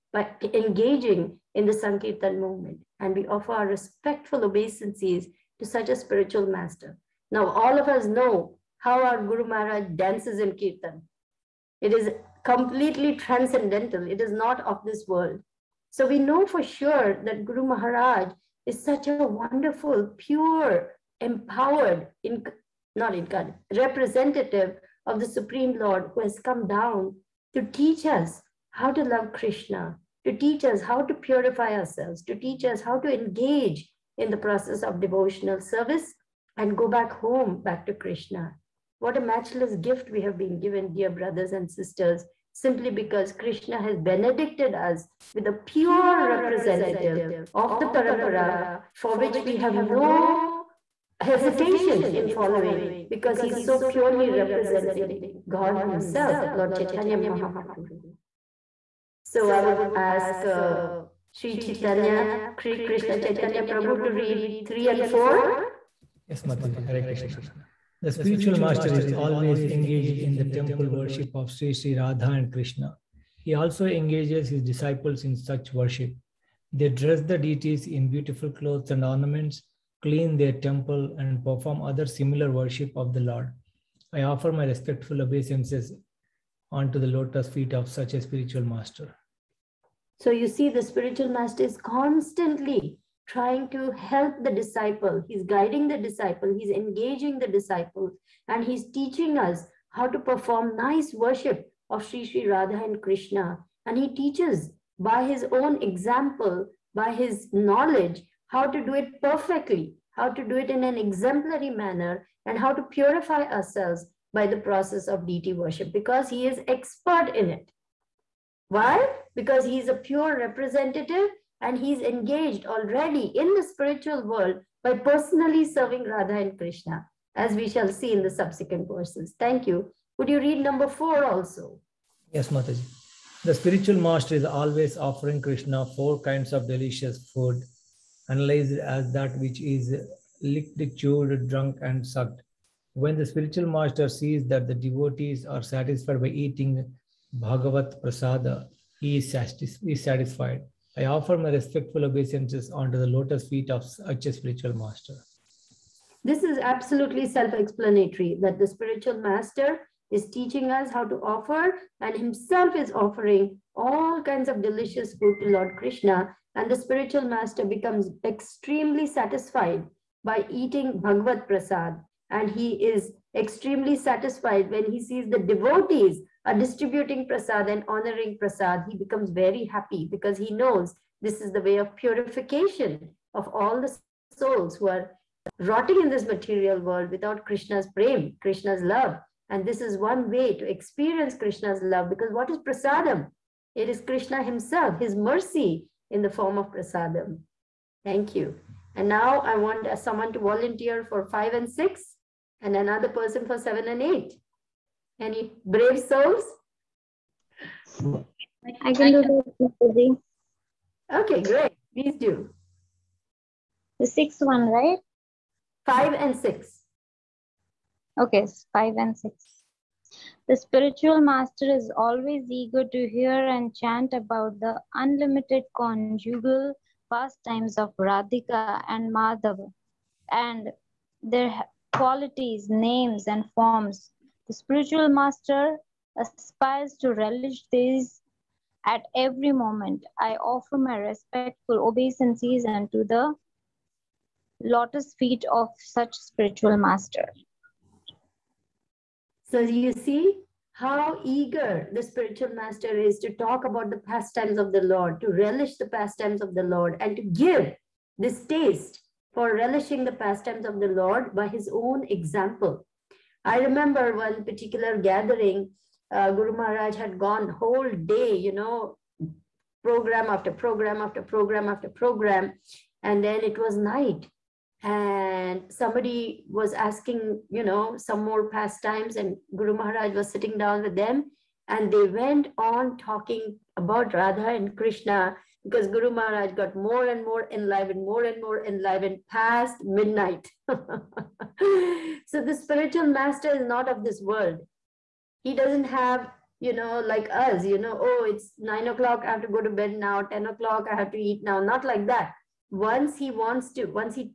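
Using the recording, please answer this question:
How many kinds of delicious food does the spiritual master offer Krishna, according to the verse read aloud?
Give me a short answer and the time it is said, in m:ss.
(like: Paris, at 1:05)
4, at 2:15.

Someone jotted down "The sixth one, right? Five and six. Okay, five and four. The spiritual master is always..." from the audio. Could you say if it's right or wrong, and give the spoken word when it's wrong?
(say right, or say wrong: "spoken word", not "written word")
wrong: "six", not "four".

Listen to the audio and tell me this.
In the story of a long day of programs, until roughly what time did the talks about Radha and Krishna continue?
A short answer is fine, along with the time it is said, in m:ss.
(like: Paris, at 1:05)
Past midnight, at 4:49.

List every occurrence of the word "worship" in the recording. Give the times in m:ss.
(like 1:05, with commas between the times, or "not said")
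1:10, 1:15, 1:22, 1:41, 1:55.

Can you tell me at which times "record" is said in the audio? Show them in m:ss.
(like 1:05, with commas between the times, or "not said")
not said.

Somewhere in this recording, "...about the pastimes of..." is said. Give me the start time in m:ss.
4:13.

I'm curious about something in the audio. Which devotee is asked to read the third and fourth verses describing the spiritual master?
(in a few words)
Sri Krishna Chaitanya Prabhu.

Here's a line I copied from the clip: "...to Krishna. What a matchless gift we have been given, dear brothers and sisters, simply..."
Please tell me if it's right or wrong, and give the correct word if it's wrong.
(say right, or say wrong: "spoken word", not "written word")
right.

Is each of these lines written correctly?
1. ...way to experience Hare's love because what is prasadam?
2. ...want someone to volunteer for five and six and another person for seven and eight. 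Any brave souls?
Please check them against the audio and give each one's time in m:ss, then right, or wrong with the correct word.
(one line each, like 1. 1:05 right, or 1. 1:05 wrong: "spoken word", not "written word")
1. 3:10 wrong: "Krishna", not "Hare"
2. 3:19 right.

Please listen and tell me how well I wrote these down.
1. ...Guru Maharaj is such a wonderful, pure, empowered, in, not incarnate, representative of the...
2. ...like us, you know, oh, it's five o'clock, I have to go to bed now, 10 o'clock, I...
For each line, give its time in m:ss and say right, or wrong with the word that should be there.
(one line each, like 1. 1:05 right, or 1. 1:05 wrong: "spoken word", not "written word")
1. 0:17 right
2. 4:57 wrong: "nine", not "five".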